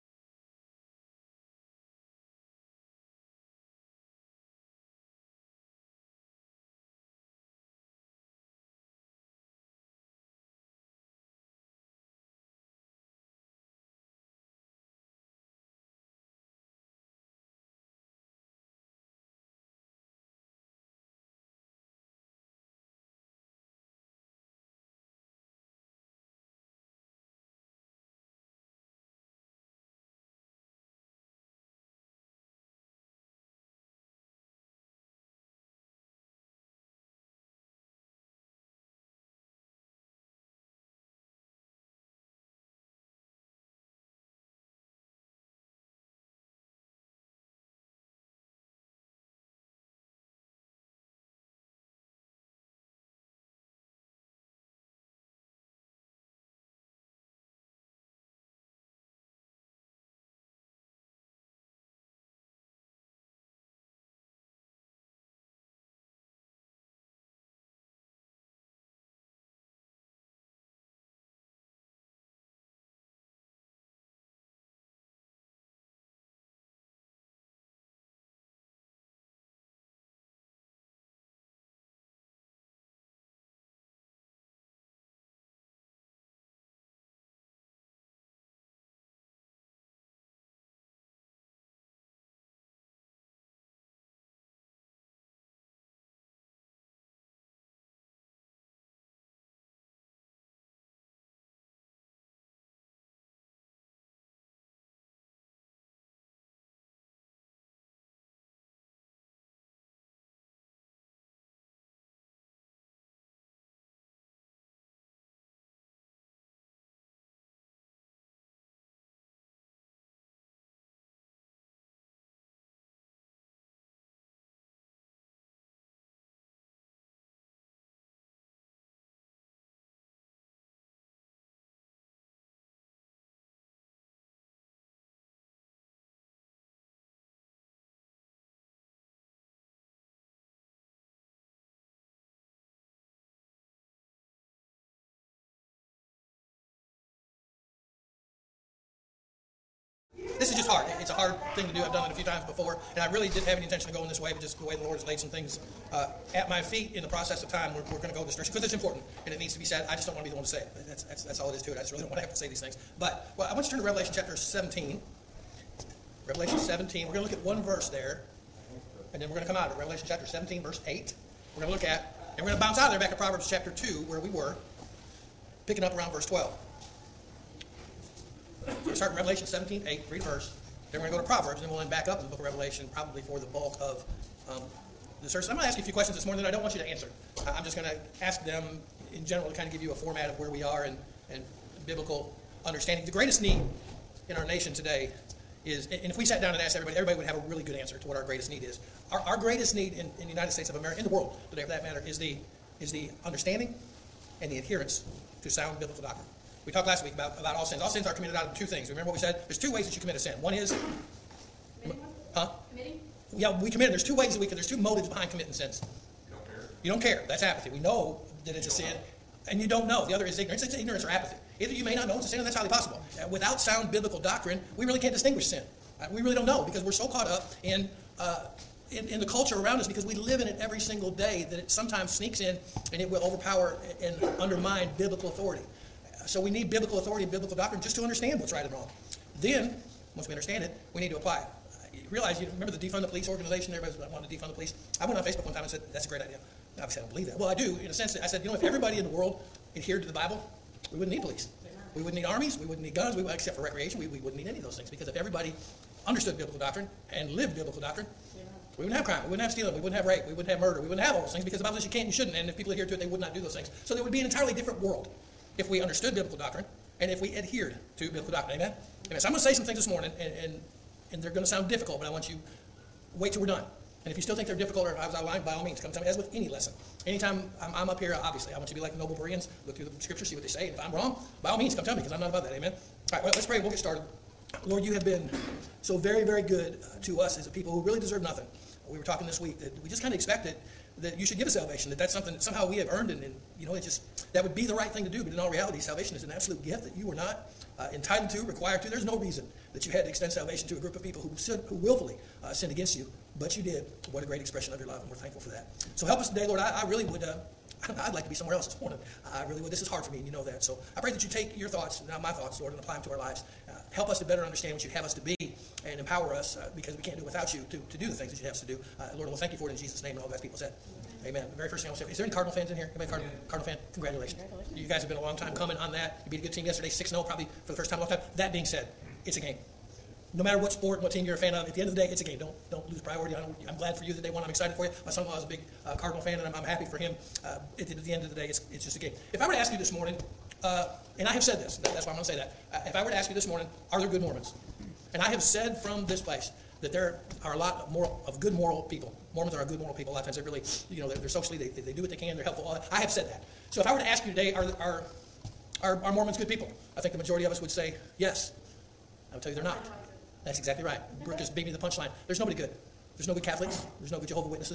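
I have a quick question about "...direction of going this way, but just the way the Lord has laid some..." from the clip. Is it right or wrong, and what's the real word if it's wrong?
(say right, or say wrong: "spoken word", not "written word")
wrong: "intention", not "direction".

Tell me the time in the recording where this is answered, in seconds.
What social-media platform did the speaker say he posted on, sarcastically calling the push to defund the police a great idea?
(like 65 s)
245 s.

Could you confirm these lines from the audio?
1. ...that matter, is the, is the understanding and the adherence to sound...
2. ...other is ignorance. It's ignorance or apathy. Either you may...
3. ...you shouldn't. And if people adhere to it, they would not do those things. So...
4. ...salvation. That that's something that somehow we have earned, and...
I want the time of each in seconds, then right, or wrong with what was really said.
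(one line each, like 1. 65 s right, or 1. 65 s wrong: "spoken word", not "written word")
1. 201 s right
2. 220 s right
3. 262 s right
4. 291 s right.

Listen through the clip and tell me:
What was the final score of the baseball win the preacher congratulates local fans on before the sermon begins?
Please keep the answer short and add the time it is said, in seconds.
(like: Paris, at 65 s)
6-0, at 326 s.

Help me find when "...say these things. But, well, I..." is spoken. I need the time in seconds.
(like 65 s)
162 s.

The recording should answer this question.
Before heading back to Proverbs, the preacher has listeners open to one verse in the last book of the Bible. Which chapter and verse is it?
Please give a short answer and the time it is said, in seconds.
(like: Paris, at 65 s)
Revelation 17:8, at 169 s.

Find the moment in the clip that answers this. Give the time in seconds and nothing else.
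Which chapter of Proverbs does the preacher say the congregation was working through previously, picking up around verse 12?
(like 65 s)
173 s.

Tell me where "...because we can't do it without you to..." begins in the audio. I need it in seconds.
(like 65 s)
316 s.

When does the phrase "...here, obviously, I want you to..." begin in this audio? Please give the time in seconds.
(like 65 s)
277 s.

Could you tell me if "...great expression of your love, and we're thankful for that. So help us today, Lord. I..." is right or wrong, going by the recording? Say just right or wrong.
right.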